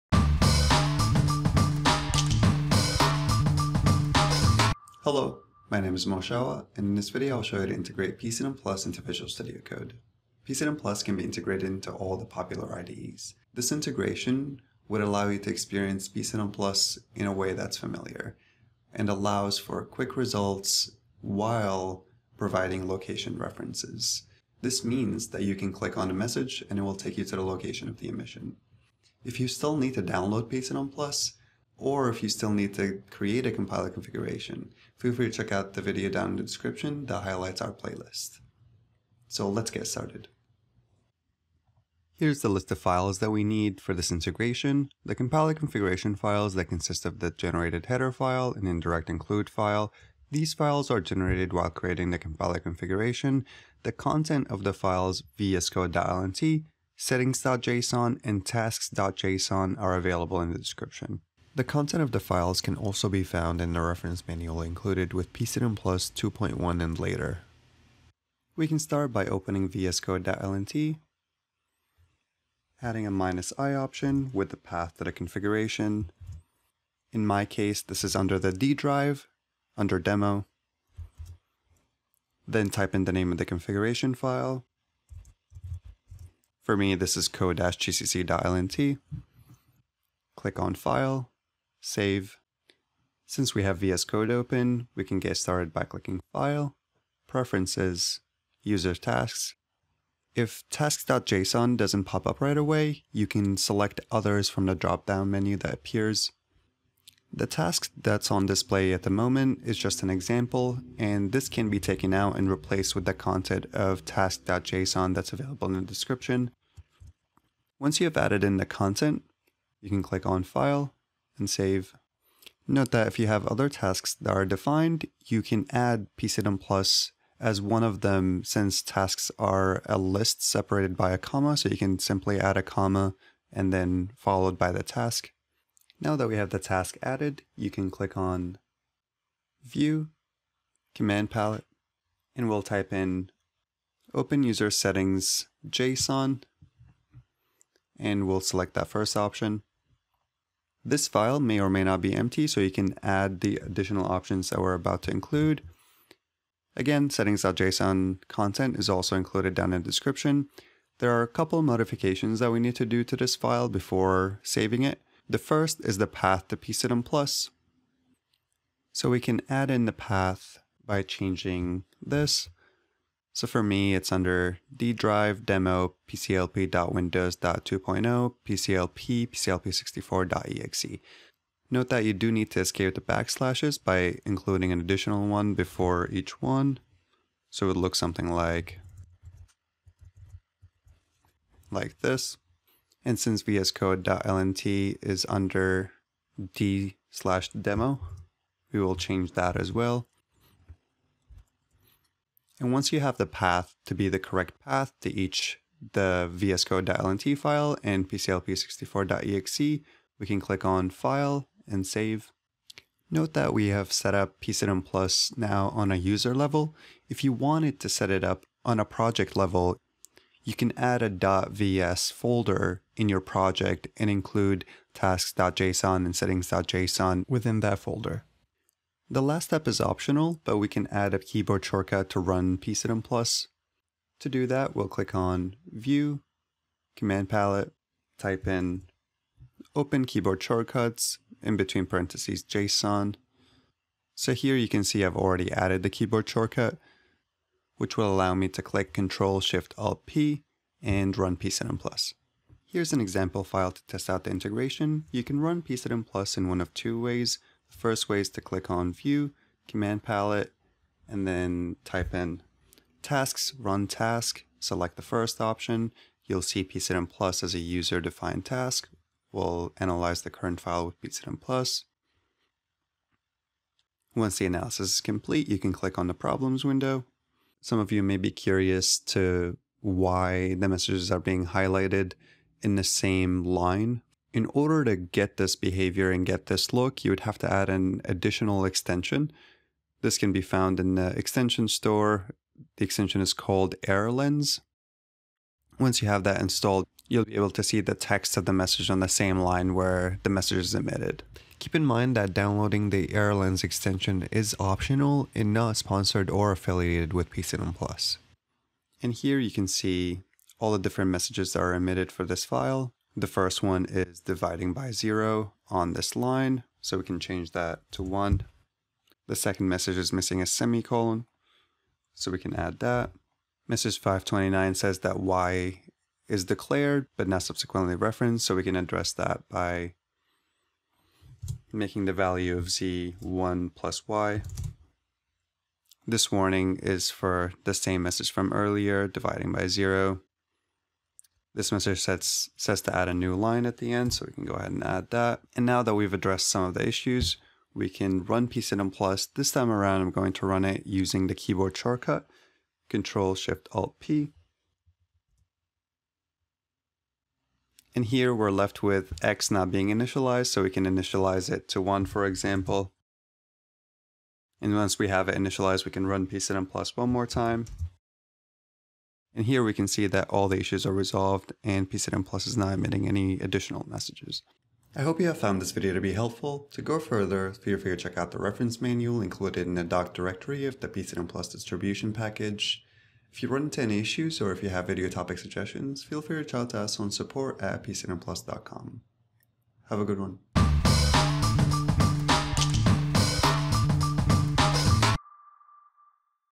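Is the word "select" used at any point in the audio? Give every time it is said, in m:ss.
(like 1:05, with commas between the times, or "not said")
1:43, 2:28, 4:24.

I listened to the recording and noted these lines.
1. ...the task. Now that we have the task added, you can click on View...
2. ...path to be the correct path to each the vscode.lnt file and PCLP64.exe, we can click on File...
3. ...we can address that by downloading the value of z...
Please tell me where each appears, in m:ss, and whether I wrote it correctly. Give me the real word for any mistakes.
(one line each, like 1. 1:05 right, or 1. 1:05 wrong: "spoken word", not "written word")
1. 2:14 right
2. 3:23 right
3. 5:28 wrong: "making", not "downloading".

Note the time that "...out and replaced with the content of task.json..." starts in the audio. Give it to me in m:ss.
1:52.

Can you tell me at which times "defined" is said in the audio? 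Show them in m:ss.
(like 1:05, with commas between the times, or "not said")
2:04, 4:27.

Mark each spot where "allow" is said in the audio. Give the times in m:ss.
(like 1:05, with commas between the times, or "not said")
0:15, 0:19, 4:08.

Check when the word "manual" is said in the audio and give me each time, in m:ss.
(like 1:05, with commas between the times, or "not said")
1:04, 6:18.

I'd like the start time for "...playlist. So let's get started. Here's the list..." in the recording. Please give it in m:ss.
0:37.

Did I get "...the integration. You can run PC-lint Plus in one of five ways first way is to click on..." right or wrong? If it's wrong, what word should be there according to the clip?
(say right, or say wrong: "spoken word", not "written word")
wrong: "two", not "five".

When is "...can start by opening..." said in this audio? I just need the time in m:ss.
1:08.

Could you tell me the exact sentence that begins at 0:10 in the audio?
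PC-lint Plus can be integrated into all the popular IDEs.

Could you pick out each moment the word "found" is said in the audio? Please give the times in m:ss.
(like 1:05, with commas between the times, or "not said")
1:03, 4:50, 6:15.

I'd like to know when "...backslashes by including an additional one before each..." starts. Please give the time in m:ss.
3:03.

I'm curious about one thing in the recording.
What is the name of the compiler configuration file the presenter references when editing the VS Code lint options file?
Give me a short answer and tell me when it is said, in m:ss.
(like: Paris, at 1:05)
code-gcc.lnt, at 1:27.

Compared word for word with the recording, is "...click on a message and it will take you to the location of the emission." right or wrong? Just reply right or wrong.
right.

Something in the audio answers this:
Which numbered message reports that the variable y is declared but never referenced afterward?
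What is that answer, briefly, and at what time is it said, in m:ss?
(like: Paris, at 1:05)
529, at 5:23.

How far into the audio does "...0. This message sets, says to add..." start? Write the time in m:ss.
5:39.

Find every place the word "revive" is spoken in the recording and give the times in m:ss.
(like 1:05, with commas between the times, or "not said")
not said.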